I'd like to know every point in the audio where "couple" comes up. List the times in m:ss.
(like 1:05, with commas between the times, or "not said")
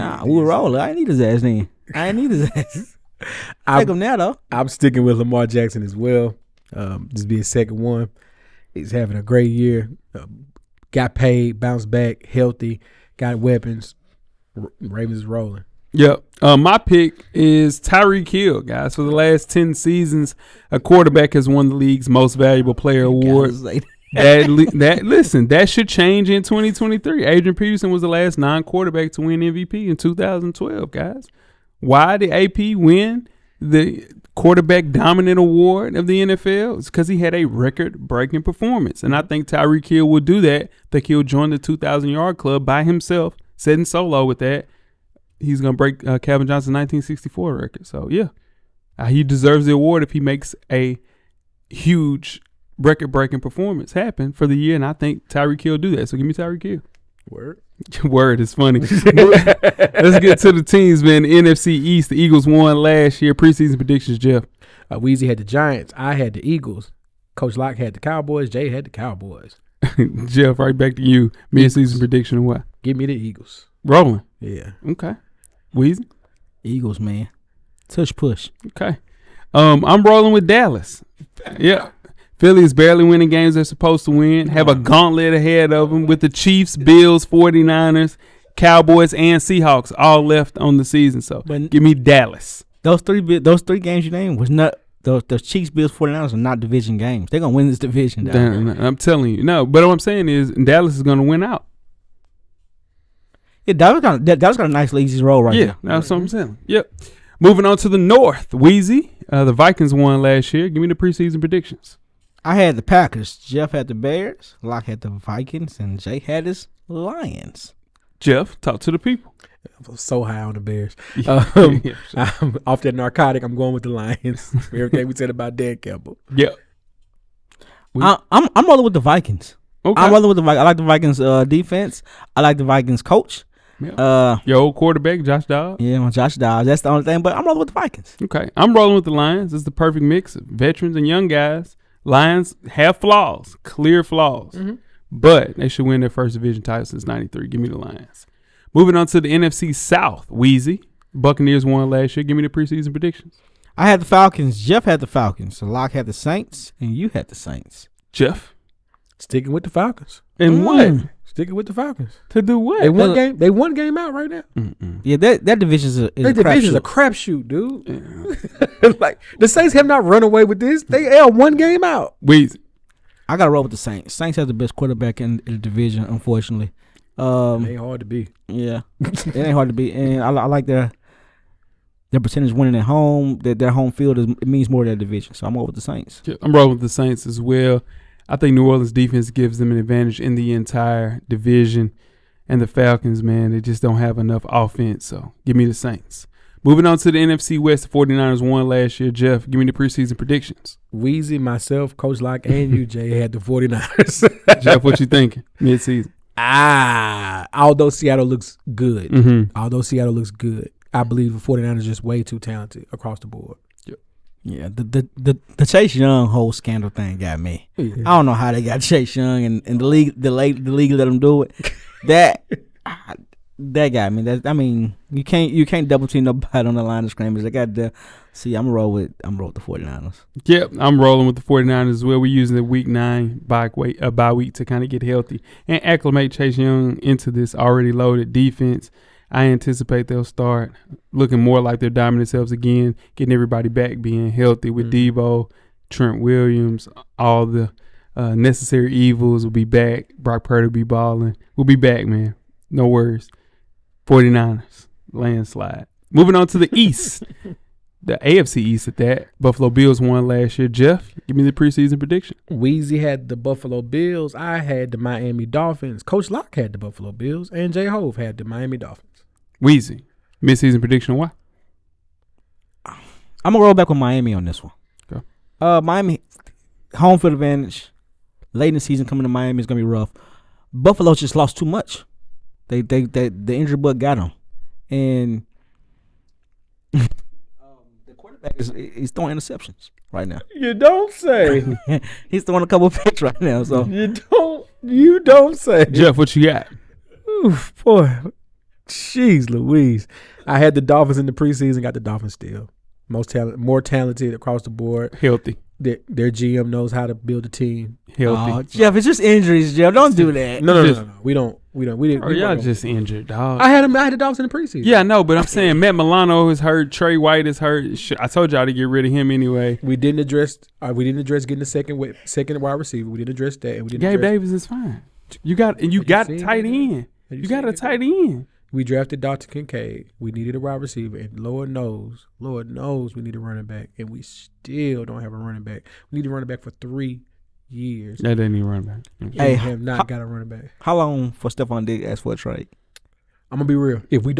4:52.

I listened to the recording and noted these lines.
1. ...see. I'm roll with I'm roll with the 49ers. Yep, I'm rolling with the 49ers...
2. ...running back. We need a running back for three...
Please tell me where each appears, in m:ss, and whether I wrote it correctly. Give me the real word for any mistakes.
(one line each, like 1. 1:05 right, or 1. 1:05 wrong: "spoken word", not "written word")
1. 3:48 right
2. 5:35 right.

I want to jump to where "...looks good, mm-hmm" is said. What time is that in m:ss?
3:28.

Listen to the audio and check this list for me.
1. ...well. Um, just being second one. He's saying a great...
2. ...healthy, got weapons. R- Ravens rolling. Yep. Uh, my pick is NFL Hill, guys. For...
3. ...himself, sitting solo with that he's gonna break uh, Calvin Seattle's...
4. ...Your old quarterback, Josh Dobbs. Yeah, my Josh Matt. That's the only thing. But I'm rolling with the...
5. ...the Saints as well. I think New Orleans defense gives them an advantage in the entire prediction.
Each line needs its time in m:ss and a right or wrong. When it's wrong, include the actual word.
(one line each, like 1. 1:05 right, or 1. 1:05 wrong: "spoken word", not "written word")
1. 0:05 wrong: "having", not "saying"
2. 0:12 wrong: "Tyreek", not "NFL"
3. 0:42 wrong: "Johnson", not "Seattle"
4. 2:14 wrong: "Dobbs", not "Matt"
5. 3:06 wrong: "division", not "prediction".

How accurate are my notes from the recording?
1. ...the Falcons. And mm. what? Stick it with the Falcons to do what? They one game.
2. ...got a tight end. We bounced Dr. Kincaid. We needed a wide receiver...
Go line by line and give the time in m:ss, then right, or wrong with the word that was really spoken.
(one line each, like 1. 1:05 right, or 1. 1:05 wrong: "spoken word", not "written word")
1. 2:39 right
2. 5:27 wrong: "drafted", not "bounced".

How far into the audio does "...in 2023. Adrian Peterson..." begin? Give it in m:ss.
0:26.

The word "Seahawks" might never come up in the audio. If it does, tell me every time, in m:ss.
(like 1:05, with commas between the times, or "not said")
1:29.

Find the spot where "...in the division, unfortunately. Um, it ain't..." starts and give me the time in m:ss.
2:55.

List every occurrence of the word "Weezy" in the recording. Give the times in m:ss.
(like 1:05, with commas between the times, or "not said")
1:04, 1:15, 1:48, 2:30, 3:20, 4:22, 4:29.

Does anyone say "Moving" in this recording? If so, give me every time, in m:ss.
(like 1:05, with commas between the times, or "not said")
1:47, 2:28, 3:16, 4:16.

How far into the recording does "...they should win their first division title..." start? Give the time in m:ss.
2:25.